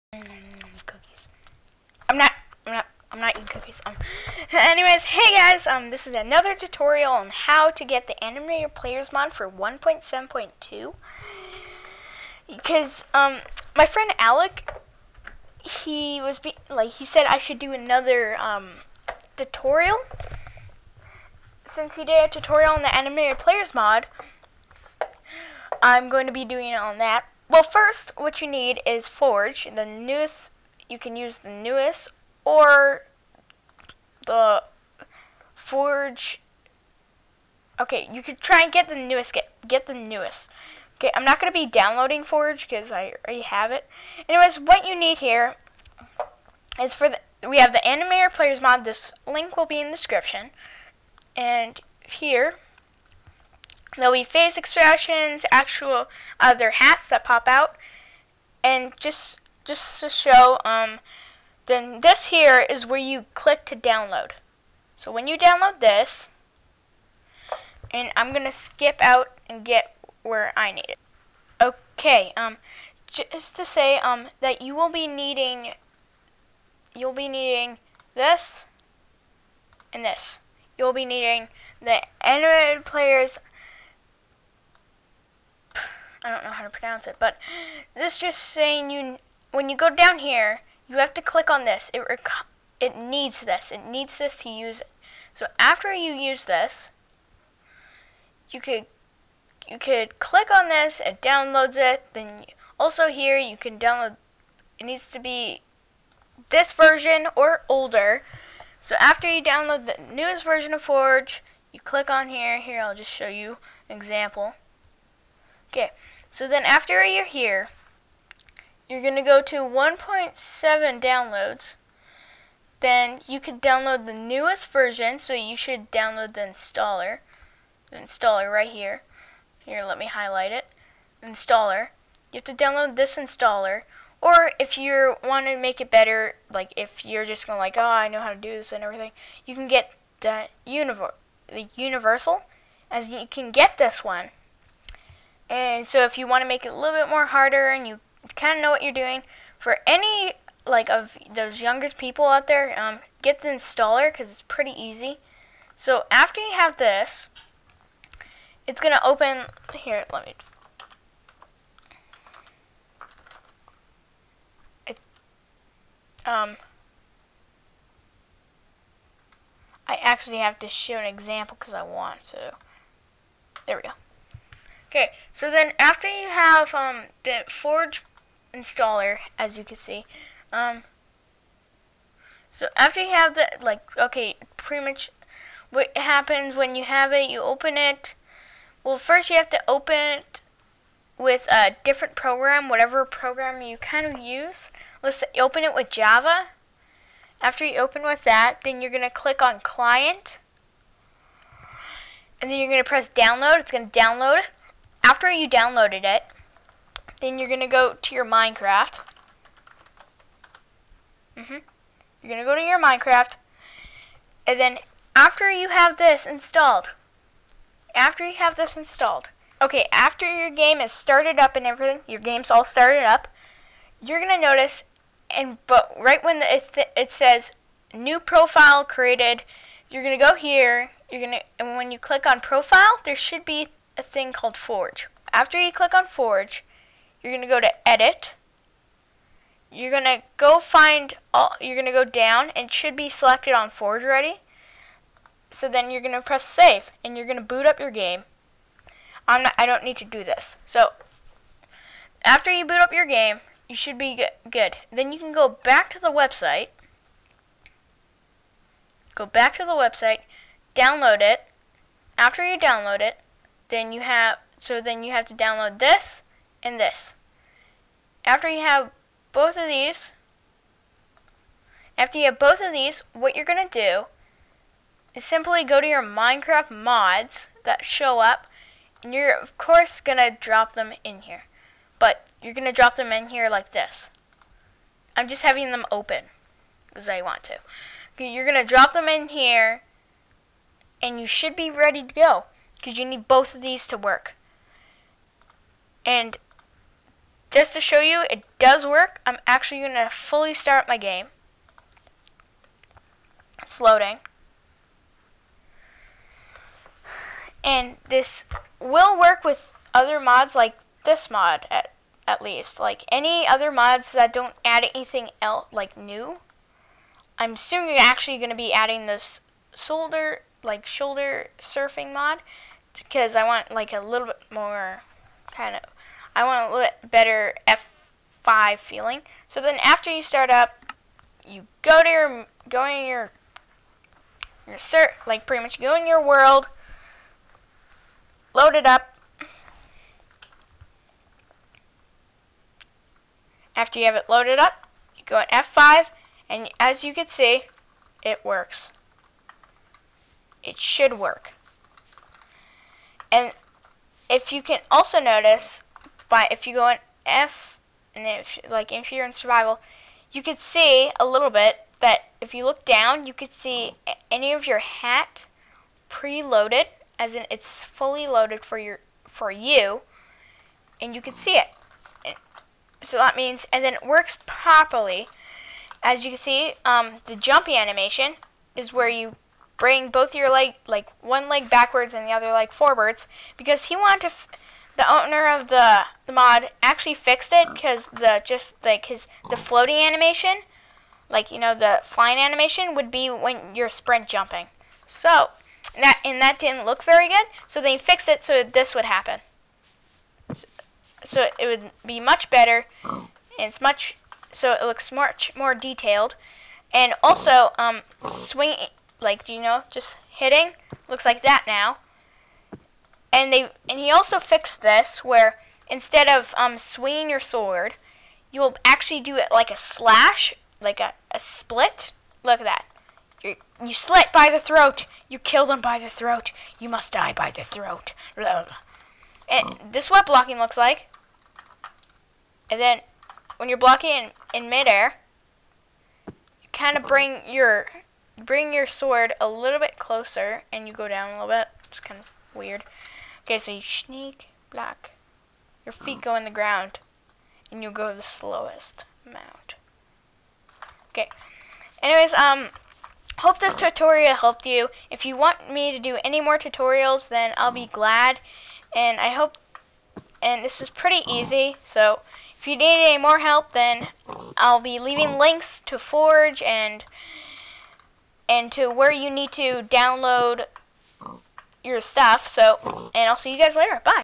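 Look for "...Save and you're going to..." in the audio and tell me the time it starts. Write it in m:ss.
4:06.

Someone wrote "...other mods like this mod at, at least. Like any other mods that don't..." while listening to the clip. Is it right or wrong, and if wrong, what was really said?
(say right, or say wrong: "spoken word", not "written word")
right.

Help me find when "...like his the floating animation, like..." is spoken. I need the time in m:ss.
6:28.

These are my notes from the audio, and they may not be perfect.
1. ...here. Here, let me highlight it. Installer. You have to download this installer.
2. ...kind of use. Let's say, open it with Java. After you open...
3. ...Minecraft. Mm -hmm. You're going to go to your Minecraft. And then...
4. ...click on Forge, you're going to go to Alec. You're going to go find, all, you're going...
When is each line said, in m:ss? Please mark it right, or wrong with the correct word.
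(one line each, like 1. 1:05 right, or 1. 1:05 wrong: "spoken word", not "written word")
1. 2:08 right
2. 3:13 right
3. 3:28 right
4. 3:55 wrong: "Edit", not "Alec".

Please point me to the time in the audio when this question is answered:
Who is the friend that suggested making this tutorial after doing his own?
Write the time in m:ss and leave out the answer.
0:14.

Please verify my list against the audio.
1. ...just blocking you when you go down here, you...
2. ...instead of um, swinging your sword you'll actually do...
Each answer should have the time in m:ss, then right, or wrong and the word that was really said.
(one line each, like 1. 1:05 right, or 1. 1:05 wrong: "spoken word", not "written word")
1. 1:28 wrong: "saying", not "blocking"
2. 6:55 right.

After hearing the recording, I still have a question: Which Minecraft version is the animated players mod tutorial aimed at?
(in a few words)
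1.7.2.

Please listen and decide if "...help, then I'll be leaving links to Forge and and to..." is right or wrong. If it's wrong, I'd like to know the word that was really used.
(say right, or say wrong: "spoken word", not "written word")
right.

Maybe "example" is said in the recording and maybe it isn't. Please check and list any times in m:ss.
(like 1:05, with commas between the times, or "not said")
1:53, 2:51.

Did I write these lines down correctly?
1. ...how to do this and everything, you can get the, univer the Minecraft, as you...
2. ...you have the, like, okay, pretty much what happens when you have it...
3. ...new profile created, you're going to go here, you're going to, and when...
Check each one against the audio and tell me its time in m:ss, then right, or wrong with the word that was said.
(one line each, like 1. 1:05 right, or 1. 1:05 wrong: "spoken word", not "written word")
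1. 2:18 wrong: "Universal", not "Minecraft"
2. 3:03 right
3. 3:47 right.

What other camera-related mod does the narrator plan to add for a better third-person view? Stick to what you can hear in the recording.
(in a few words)
shoulder surfing mod.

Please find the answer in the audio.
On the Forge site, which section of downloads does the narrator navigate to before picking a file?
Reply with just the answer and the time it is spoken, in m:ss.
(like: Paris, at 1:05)
1.7 downloads, at 1:59.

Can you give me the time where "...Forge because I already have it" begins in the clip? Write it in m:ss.
0:42.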